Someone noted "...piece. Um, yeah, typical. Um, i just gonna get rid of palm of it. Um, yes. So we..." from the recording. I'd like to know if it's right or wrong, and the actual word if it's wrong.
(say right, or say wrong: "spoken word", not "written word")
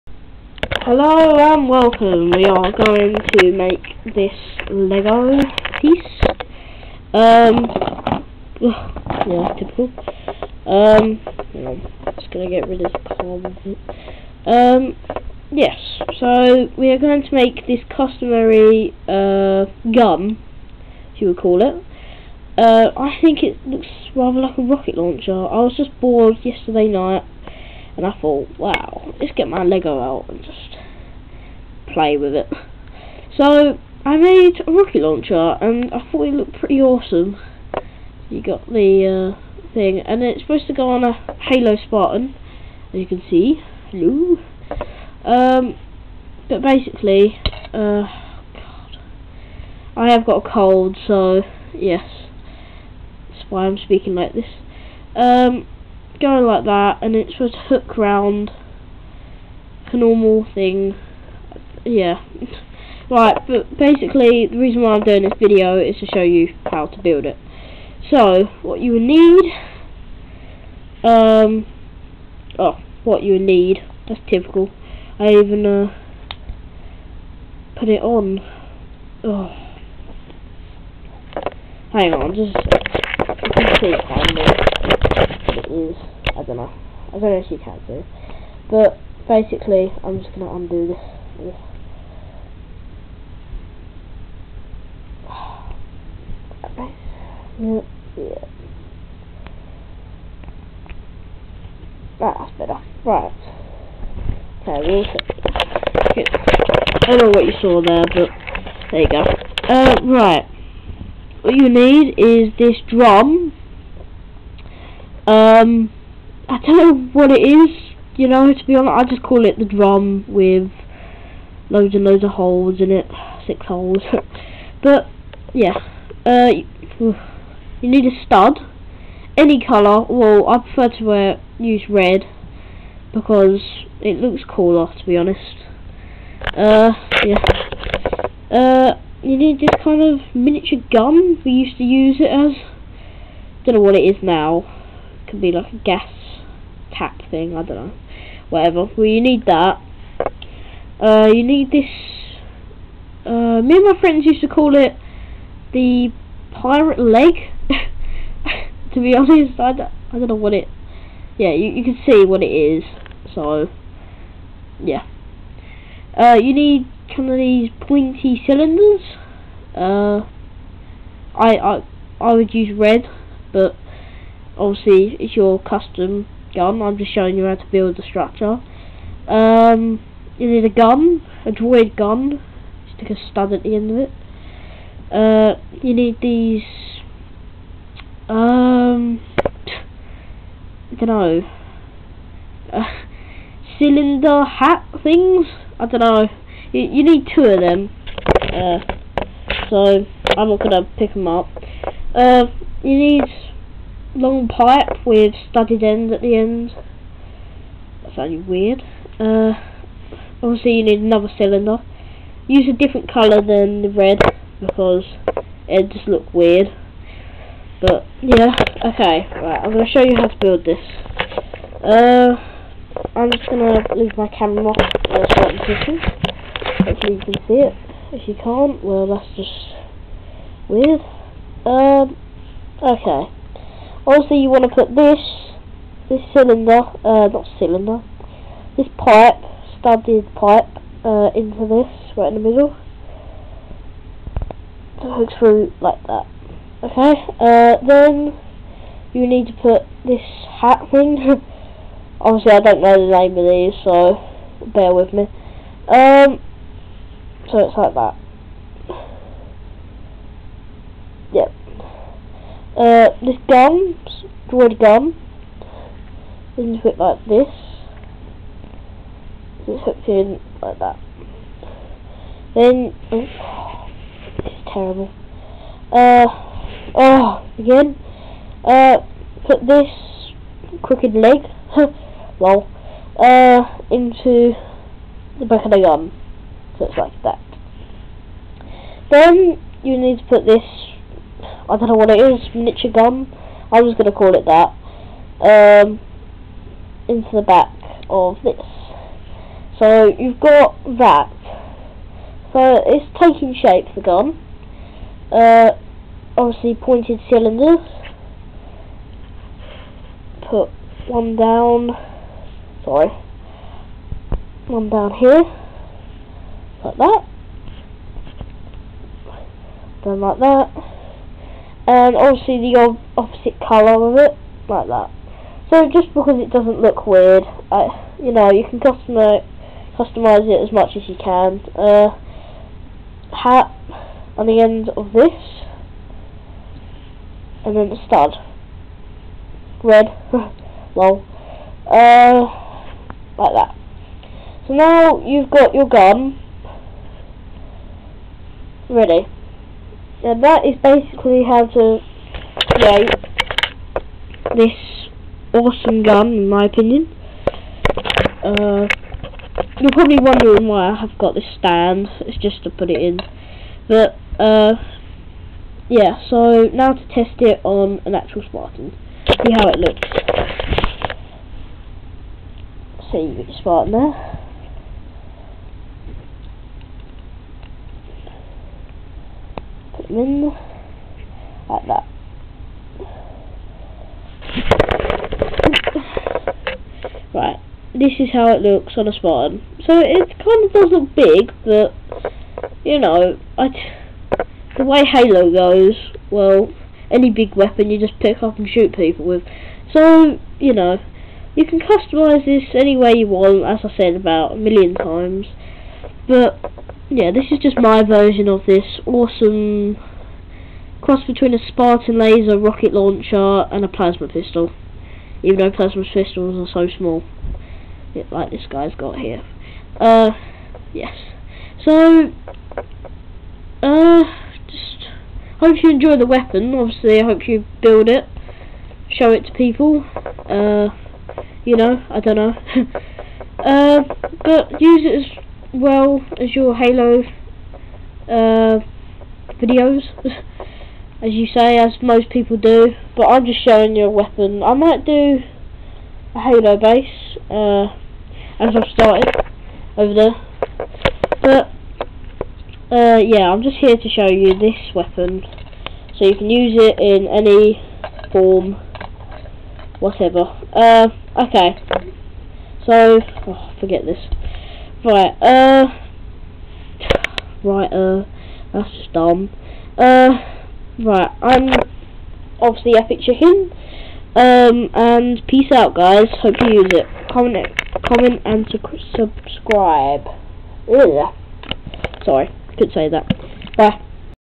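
right.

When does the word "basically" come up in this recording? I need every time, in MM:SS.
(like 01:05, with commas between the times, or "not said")
00:46, 01:03, 01:29, 05:50.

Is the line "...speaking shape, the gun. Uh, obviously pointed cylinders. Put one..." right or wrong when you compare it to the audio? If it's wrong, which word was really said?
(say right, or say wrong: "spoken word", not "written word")
wrong: "taking", not "speaking".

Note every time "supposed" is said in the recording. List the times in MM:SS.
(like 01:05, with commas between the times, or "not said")
00:40, 00:57.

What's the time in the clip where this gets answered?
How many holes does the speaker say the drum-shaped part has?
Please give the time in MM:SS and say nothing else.
02:03.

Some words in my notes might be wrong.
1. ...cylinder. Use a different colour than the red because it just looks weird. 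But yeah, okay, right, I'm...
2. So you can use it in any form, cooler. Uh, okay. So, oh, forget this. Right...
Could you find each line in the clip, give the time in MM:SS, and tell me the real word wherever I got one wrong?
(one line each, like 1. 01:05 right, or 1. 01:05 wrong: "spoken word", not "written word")
1. 03:31 right
2. 07:36 wrong: "whatever", not "cooler".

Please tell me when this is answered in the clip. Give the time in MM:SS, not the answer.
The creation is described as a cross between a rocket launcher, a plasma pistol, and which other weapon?
06:51.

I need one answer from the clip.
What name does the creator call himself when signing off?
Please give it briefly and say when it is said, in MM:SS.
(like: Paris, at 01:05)
Epic Chicken, at 07:52.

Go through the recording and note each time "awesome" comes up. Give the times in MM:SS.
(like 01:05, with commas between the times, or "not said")
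00:36, 05:55, 06:49.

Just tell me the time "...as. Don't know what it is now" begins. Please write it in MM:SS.
02:22.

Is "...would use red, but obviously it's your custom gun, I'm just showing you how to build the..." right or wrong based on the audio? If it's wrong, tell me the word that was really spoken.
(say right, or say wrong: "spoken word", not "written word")
right.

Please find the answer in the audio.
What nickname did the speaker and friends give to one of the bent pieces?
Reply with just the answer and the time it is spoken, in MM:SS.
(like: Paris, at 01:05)
The pirate leg, at 02:35.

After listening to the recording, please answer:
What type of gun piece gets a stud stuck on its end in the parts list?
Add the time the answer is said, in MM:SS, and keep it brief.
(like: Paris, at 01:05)
Droid gun, at 03:01.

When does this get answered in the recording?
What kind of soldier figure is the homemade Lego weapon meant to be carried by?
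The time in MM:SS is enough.
00:41.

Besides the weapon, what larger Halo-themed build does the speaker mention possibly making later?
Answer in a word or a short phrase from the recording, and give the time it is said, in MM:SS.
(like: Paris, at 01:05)
A Halo base, at 07:26.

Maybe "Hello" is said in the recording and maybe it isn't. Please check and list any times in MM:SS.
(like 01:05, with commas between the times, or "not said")
00:00, 00:43.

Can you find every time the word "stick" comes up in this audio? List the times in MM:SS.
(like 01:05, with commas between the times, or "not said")
03:02.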